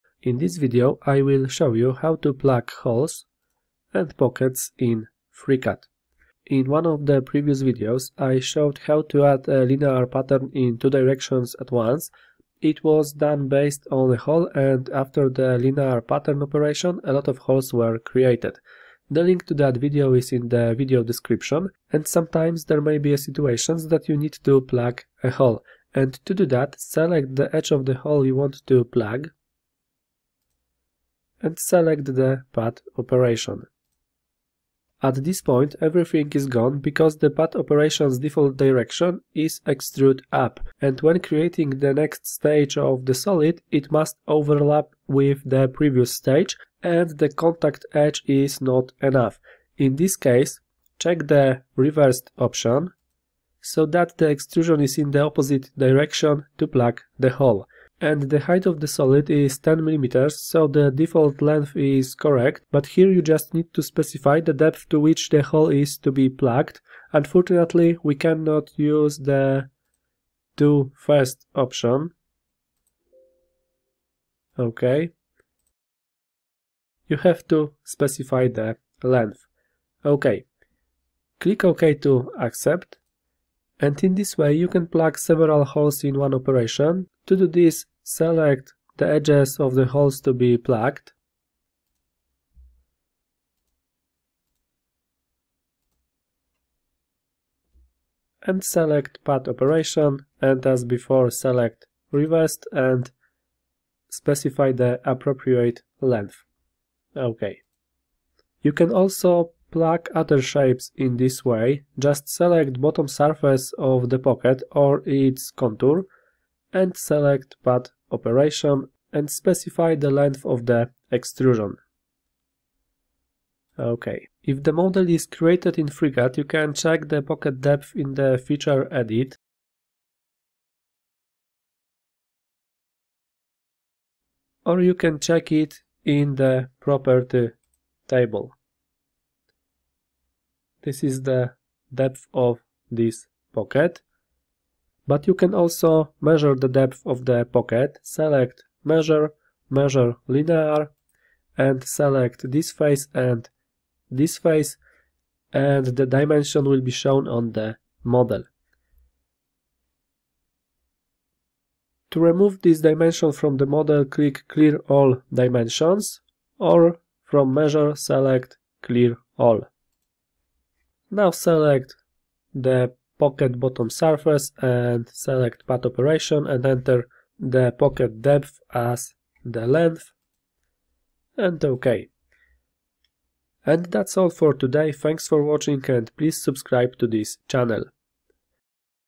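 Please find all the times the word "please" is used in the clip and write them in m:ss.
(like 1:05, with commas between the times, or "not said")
3:06.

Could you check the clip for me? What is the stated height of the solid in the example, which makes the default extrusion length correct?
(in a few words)
10 millimeters.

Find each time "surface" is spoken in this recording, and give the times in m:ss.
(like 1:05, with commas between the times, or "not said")
1:53, 2:54.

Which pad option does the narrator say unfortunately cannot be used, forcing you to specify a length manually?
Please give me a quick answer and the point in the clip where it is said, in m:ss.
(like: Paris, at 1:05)
Do first, at 1:10.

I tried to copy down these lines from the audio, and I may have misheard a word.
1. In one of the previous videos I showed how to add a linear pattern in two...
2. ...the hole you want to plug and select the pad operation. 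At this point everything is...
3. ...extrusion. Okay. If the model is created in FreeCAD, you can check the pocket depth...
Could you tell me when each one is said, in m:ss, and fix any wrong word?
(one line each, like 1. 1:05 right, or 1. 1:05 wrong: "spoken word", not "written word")
1. 0:06 right
2. 0:27 right
3. 2:01 right.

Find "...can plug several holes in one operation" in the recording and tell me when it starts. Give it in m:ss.
1:24.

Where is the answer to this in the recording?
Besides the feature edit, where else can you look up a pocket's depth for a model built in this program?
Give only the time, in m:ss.
2:16.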